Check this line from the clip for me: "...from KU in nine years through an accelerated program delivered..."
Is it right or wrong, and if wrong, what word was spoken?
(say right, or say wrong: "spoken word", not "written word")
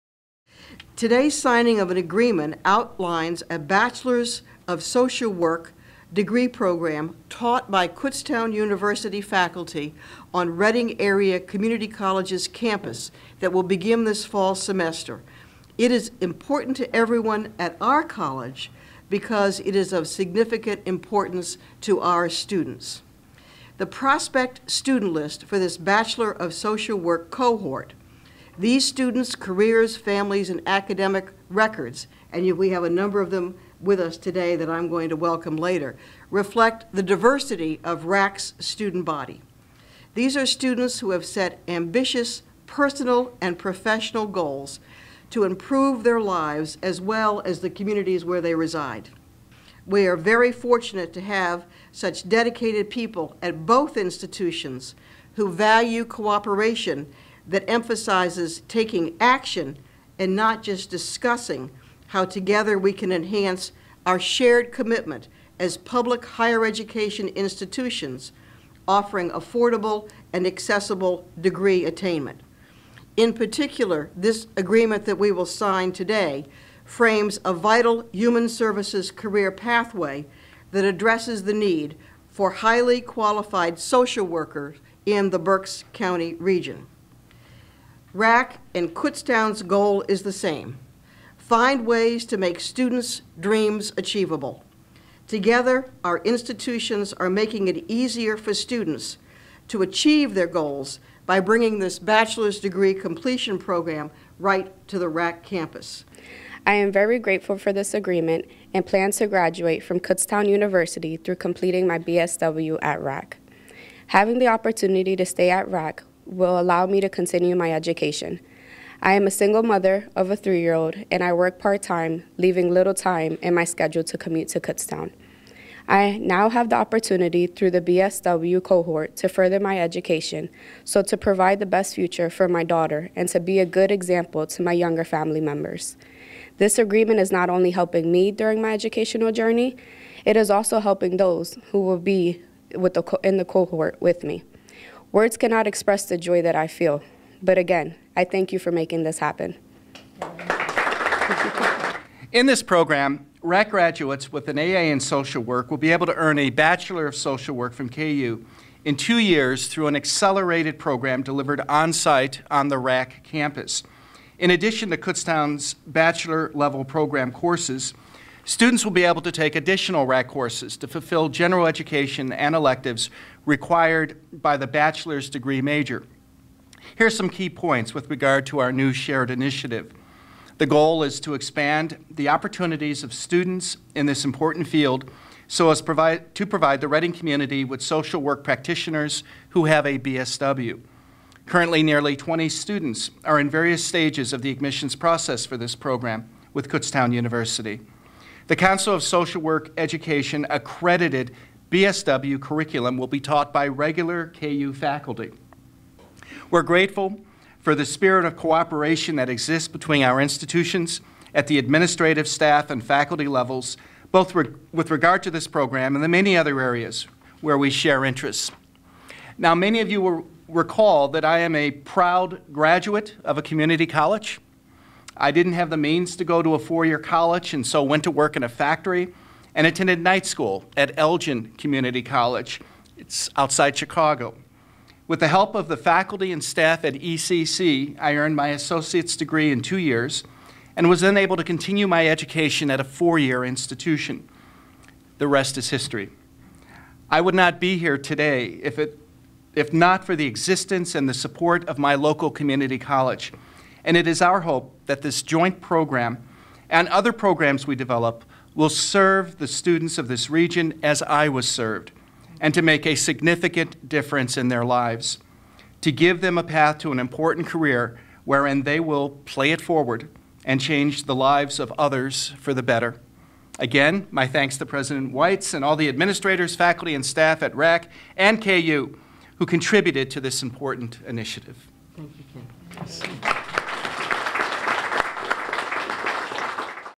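wrong: "two", not "nine".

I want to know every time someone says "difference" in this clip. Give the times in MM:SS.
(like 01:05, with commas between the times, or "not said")
04:23.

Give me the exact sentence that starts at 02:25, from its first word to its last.
Words cannot express the joy that I feel.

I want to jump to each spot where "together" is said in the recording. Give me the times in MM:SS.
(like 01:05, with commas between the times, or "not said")
01:02, 01:35.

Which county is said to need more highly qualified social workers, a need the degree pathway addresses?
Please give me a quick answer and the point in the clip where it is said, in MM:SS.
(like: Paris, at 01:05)
Berks County, at 01:25.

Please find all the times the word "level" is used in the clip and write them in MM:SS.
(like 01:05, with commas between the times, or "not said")
02:46, 03:33.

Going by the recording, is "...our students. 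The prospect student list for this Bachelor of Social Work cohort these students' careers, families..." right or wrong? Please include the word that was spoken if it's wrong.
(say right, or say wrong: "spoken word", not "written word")
right.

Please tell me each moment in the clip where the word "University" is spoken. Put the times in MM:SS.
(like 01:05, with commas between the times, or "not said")
00:08, 01:50, 03:17.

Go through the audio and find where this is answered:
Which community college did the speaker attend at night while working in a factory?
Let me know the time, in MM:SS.
03:50.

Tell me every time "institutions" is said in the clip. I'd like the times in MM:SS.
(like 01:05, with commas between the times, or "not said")
00:53, 01:07, 01:36, 03:30, 04:03.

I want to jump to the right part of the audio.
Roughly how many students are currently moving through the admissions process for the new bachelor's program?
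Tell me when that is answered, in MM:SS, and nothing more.
03:11.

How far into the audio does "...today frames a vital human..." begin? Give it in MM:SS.
01:15.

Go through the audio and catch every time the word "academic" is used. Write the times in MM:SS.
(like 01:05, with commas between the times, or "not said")
00:30.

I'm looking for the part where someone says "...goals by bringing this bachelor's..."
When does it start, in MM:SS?
01:40.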